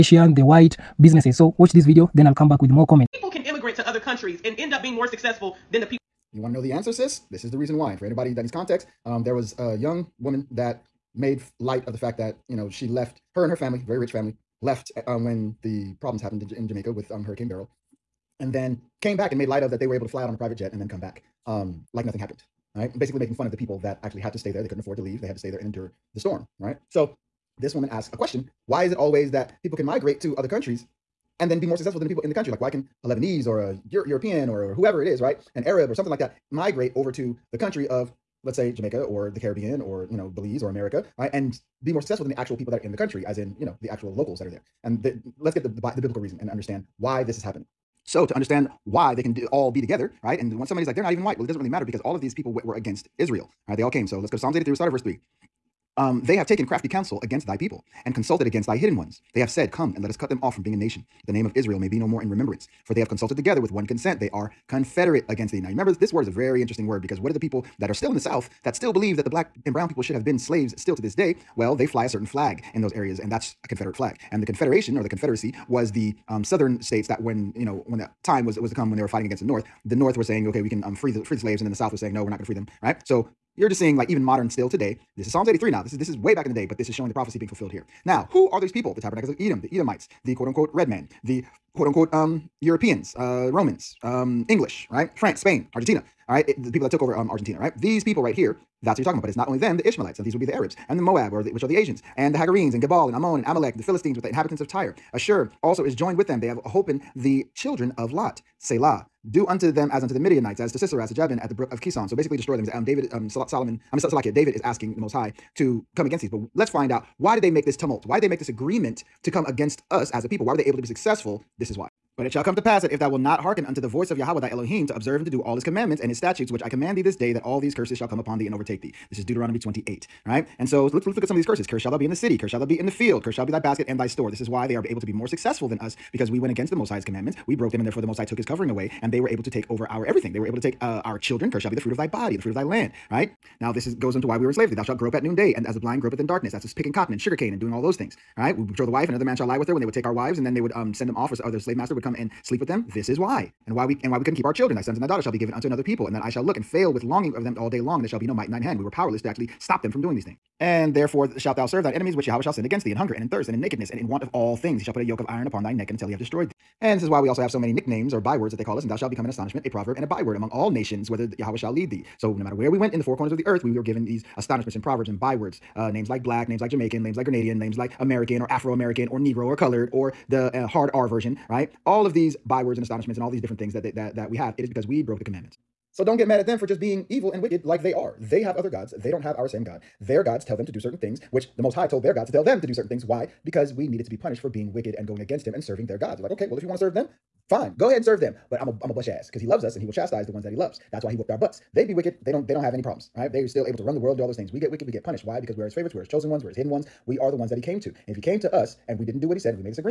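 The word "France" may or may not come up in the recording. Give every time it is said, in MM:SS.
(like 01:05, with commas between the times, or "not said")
01:35.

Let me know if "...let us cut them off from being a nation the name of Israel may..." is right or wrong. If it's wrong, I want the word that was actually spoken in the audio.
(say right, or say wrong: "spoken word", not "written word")
right.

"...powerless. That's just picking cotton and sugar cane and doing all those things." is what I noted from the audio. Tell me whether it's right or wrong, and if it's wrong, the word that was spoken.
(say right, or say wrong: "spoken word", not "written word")
wrong: "darkness", not "powerless".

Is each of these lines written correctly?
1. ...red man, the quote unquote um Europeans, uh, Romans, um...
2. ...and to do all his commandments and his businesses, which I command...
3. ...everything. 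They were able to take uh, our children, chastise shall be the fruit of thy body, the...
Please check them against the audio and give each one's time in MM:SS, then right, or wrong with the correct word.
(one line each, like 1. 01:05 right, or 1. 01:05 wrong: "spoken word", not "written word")
1. 01:30 right
2. 02:05 wrong: "statutes", not "businesses"
3. 02:20 wrong: "curse", not "chastise".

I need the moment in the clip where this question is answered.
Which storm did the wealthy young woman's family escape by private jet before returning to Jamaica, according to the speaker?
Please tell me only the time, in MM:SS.
00:17.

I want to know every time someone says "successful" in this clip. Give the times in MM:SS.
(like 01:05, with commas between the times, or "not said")
00:05, 00:31, 00:42, 02:00, 02:15.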